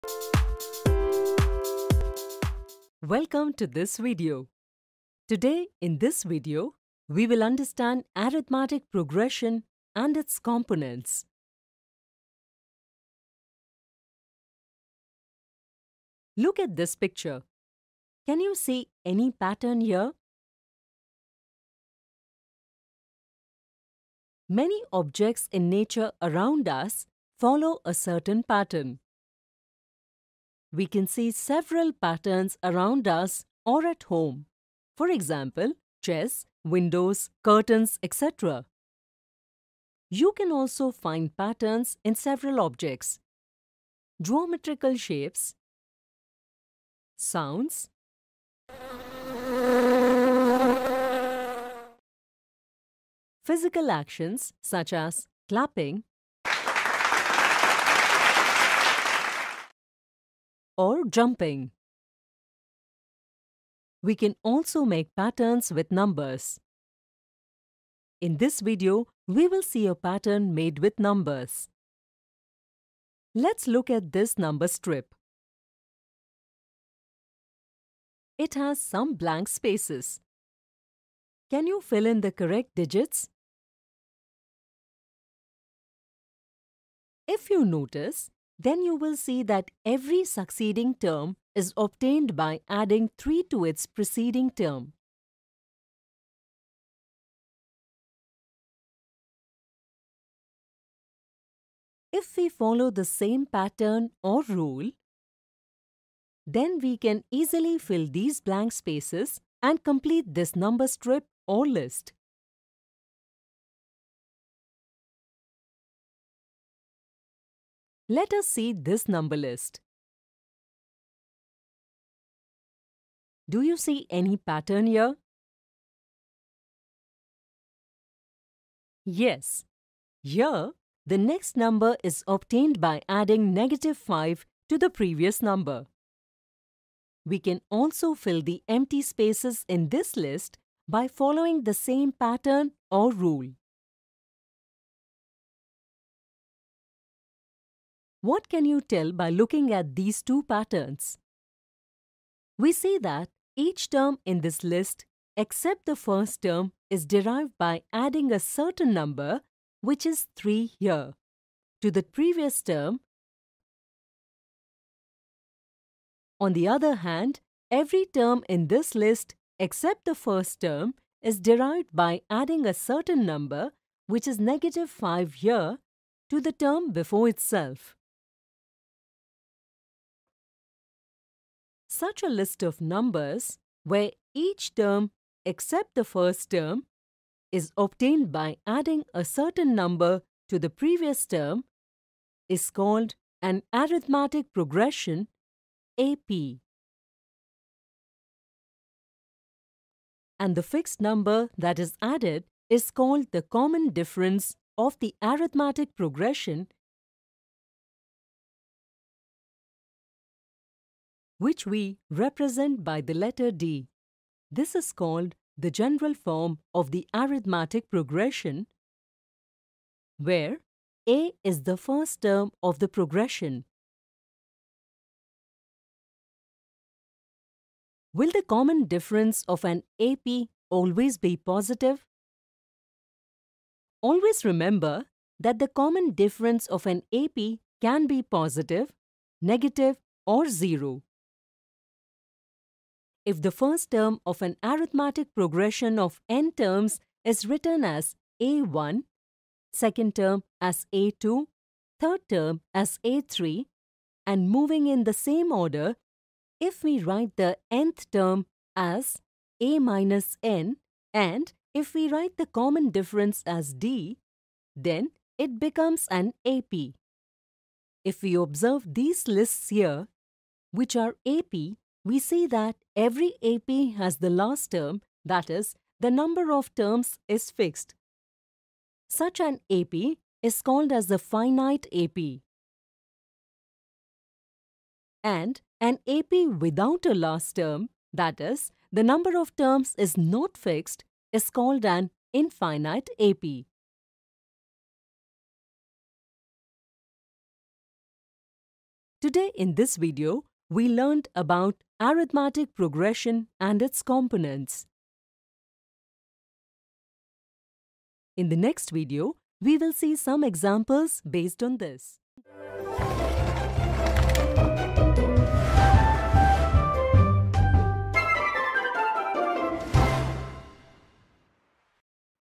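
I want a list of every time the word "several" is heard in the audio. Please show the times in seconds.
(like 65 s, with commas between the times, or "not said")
31 s, 42 s.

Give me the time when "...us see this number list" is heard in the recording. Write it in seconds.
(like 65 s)
118 s.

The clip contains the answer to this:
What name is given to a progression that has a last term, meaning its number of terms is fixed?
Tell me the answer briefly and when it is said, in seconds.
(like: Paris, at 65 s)
finite AP, at 281 s.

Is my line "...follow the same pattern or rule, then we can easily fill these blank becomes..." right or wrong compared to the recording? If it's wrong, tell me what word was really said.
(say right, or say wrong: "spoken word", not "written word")
wrong: "spaces", not "becomes".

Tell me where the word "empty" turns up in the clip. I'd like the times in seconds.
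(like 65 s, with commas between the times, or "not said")
138 s.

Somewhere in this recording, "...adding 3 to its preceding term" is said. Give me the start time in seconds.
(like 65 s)
92 s.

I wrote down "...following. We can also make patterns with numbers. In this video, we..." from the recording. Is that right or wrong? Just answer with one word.
wrong.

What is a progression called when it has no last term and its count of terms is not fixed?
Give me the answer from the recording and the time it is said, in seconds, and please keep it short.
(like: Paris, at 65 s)
infinite AP, at 292 s.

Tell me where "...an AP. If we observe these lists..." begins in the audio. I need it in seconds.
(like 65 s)
266 s.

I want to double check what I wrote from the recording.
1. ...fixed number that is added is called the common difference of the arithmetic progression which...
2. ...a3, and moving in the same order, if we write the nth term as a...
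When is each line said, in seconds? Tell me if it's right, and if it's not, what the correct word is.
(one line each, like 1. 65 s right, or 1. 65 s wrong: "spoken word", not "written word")
1. 200 s right
2. 253 s right.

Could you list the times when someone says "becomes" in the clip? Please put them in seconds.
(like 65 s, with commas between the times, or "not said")
265 s.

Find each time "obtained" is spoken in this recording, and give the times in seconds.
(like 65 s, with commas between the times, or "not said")
91 s, 132 s, 187 s.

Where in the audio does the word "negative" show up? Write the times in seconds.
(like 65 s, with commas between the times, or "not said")
133 s, 174 s, 239 s.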